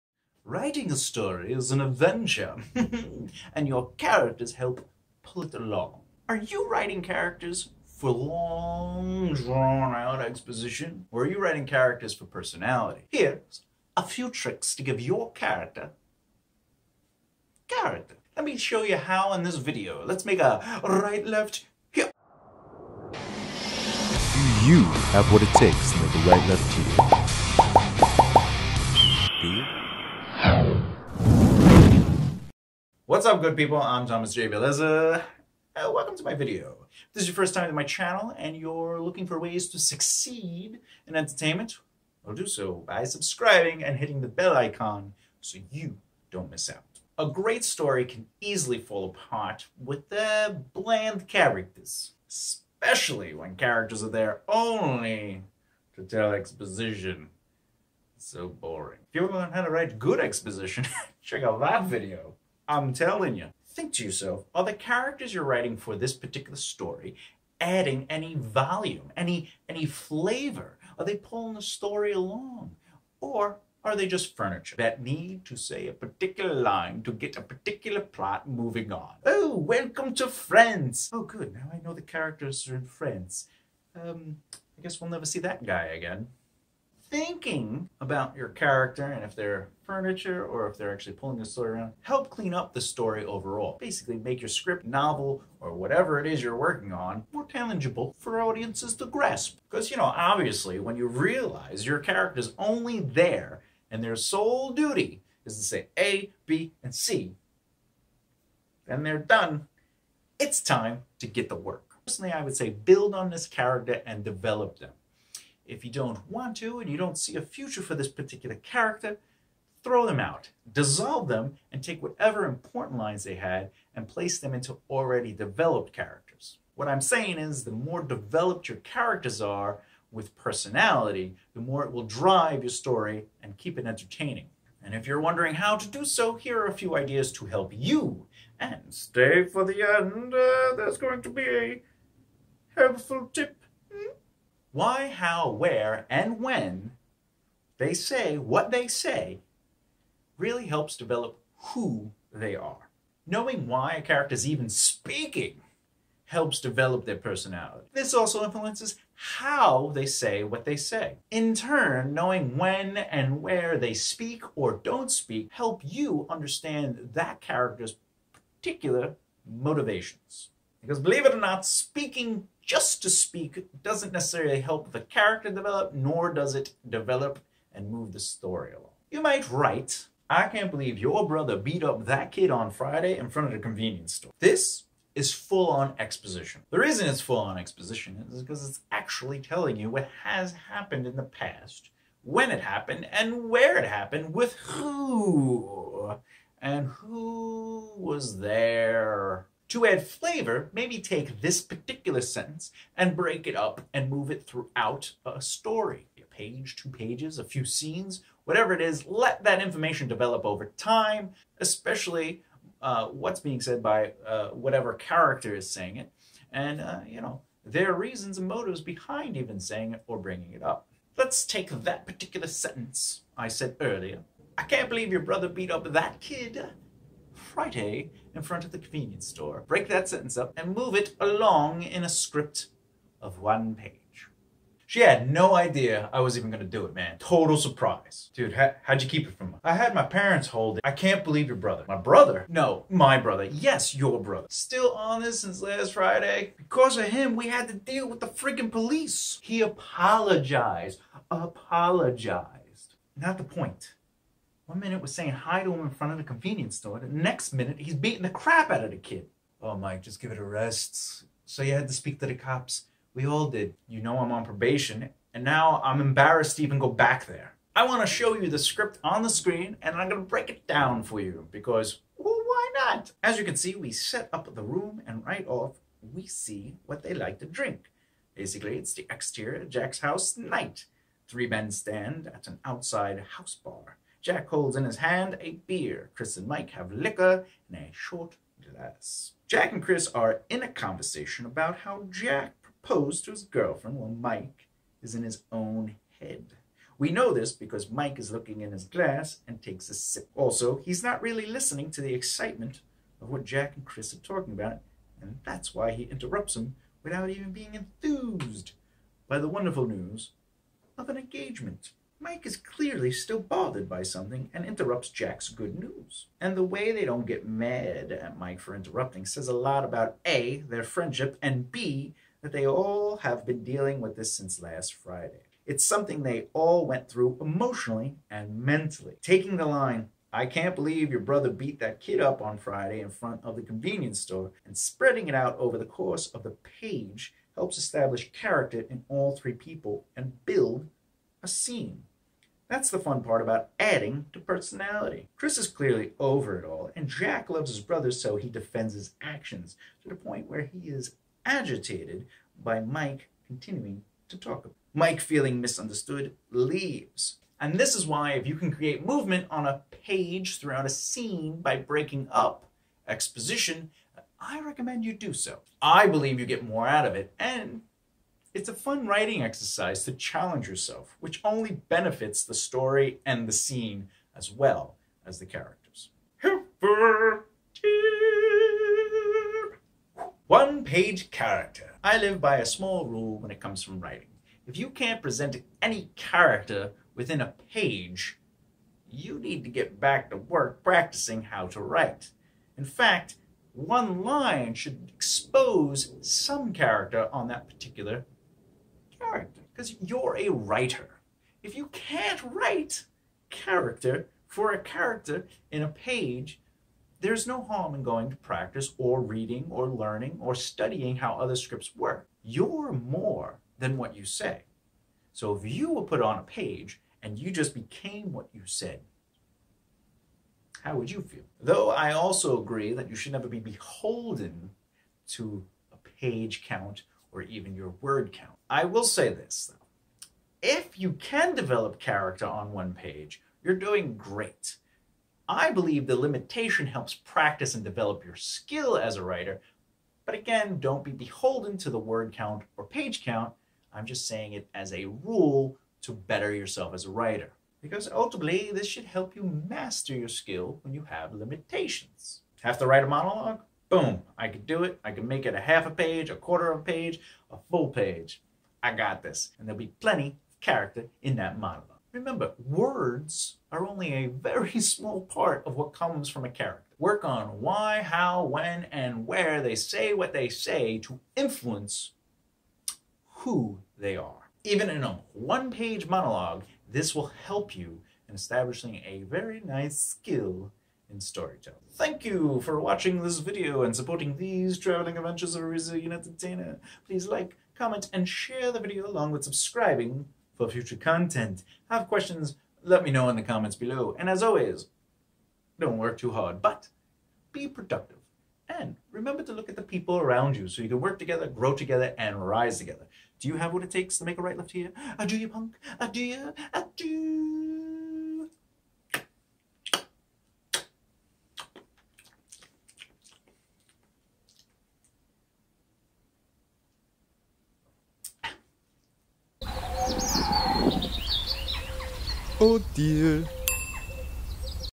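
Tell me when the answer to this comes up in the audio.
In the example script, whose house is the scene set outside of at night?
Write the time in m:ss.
4:39.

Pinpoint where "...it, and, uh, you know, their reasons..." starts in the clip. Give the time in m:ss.
3:35.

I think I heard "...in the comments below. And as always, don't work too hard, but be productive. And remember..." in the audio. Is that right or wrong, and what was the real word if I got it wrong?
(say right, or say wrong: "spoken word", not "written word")
right.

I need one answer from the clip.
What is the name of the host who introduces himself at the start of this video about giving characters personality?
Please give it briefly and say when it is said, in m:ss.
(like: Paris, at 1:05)
Thomas J. Bellezza, at 0:34.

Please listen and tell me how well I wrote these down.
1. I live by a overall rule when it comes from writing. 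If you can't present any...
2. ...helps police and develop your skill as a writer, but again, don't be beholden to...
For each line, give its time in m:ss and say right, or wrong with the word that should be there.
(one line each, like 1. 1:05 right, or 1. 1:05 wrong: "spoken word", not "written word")
1. 6:22 wrong: "small", not "overall"
2. 7:16 wrong: "practice", not "police".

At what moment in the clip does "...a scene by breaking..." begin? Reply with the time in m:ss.
6:00.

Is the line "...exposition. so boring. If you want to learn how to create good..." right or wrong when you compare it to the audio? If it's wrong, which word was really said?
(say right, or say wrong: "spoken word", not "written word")
wrong: "write", not "create".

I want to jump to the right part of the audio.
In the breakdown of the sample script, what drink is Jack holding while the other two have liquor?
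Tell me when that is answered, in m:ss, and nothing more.
4:45.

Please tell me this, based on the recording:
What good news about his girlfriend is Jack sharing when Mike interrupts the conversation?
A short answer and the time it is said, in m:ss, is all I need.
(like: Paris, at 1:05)
an engagement, at 5:11.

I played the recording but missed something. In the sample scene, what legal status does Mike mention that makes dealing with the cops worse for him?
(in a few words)
probation.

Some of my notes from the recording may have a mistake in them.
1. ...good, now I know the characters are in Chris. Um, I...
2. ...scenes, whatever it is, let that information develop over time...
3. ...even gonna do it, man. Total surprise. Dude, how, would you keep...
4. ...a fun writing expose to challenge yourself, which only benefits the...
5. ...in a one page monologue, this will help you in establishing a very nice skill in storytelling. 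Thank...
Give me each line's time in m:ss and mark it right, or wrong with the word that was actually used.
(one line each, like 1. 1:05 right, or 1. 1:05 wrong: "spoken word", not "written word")
1. 1:21 wrong: "Friends", not "Chris"
2. 3:27 right
3. 3:56 right
4. 6:08 wrong: "exercise", not "expose"
5. 7:54 right.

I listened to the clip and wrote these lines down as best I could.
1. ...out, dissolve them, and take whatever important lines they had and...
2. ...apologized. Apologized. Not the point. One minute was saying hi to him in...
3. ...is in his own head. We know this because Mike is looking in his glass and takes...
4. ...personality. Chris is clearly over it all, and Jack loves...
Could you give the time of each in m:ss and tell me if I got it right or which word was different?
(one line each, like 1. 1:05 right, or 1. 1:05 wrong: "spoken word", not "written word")
1. 2:00 right
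2. 4:09 right
3. 4:55 right
4. 5:44 right.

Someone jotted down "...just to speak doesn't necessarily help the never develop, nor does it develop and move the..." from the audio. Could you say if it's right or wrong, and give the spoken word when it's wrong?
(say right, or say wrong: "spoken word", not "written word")
wrong: "character", not "never".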